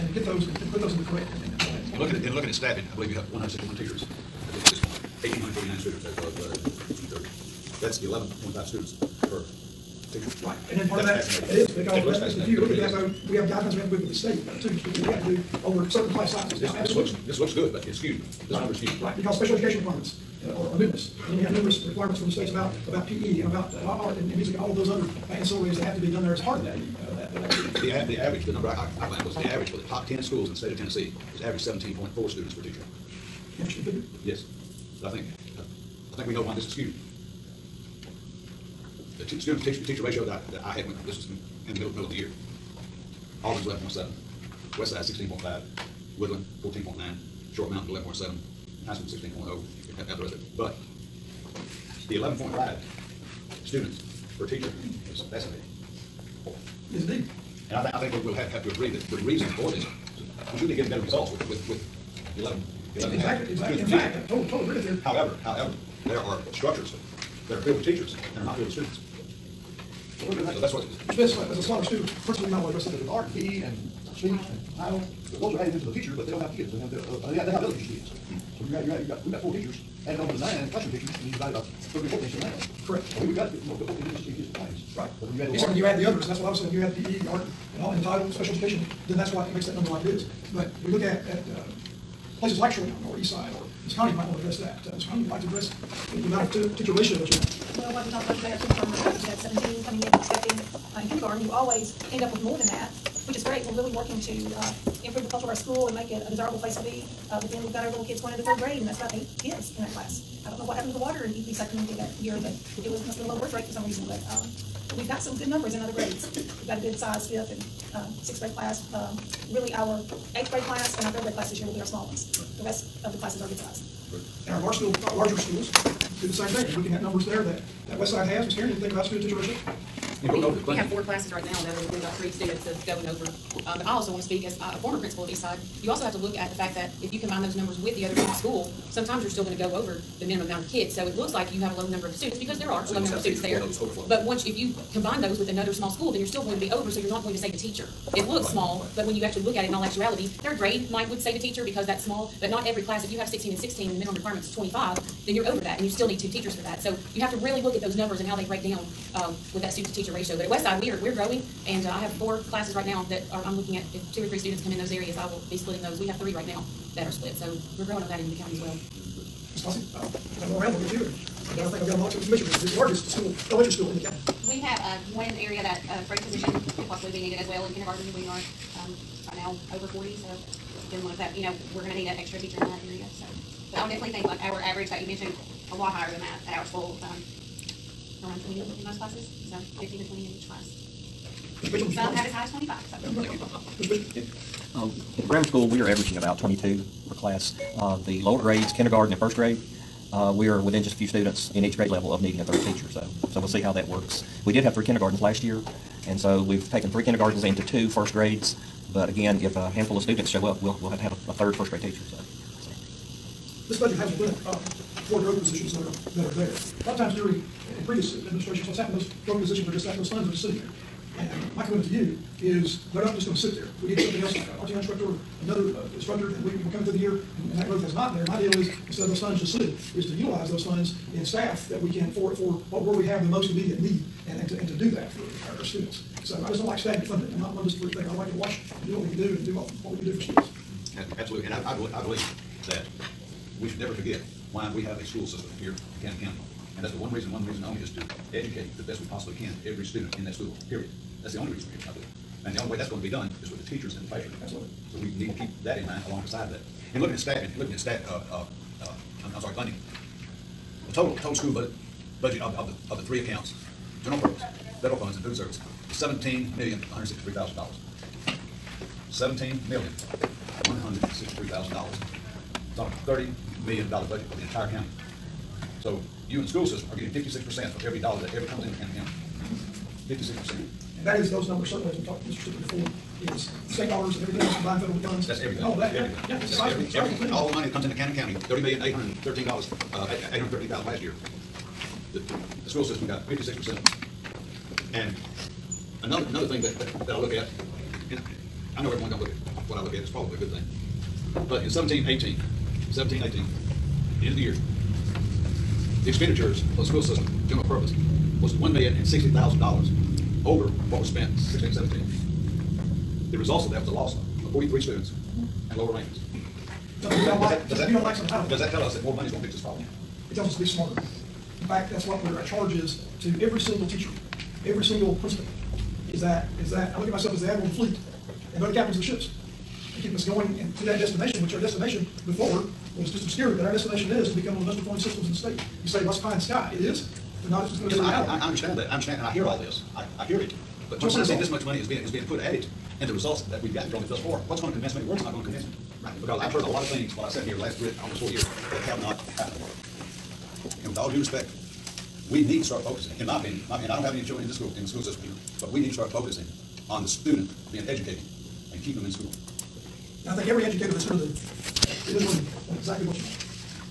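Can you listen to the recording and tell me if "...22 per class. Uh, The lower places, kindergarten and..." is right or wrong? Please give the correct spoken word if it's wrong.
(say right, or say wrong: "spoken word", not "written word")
wrong: "grades", not "places".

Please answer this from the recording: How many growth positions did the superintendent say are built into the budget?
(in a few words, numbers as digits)
4.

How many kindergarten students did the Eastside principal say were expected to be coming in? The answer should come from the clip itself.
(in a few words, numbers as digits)
17.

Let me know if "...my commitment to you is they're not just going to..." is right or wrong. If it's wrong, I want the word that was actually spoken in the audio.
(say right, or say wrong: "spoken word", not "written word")
right.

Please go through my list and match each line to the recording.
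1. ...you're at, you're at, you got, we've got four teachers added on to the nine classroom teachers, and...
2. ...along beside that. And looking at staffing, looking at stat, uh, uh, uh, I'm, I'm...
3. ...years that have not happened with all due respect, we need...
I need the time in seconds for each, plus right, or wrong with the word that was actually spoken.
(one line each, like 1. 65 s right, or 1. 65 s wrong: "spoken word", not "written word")
1. 78 s right
2. 256 s right
3. 348 s right.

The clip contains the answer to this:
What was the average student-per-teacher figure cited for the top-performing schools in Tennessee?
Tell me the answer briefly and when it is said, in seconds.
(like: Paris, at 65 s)
17.4, at 31 s.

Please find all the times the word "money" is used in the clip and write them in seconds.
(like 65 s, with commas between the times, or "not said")
287 s, 319 s, 341 s.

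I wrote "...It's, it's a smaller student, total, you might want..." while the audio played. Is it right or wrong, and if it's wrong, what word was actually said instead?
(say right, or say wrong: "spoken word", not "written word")
wrong: "principal", not "total".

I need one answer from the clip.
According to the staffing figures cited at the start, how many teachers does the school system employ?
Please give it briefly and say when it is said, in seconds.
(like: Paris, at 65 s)
161, at 3 s.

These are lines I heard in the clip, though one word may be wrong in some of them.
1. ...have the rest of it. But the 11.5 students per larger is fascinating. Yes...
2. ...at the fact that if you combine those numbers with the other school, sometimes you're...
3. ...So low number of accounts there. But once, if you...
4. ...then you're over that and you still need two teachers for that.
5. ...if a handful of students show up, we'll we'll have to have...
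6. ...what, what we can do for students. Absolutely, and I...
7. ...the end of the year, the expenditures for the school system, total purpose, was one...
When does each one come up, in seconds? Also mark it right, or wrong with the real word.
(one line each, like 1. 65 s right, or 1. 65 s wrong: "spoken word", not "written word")
1. 50 s wrong: "teacher", not "larger"
2. 136 s right
3. 142 s wrong: "students", not "accounts"
4. 155 s right
5. 209 s right
6. 239 s right
7. 304 s wrong: "general", not "total".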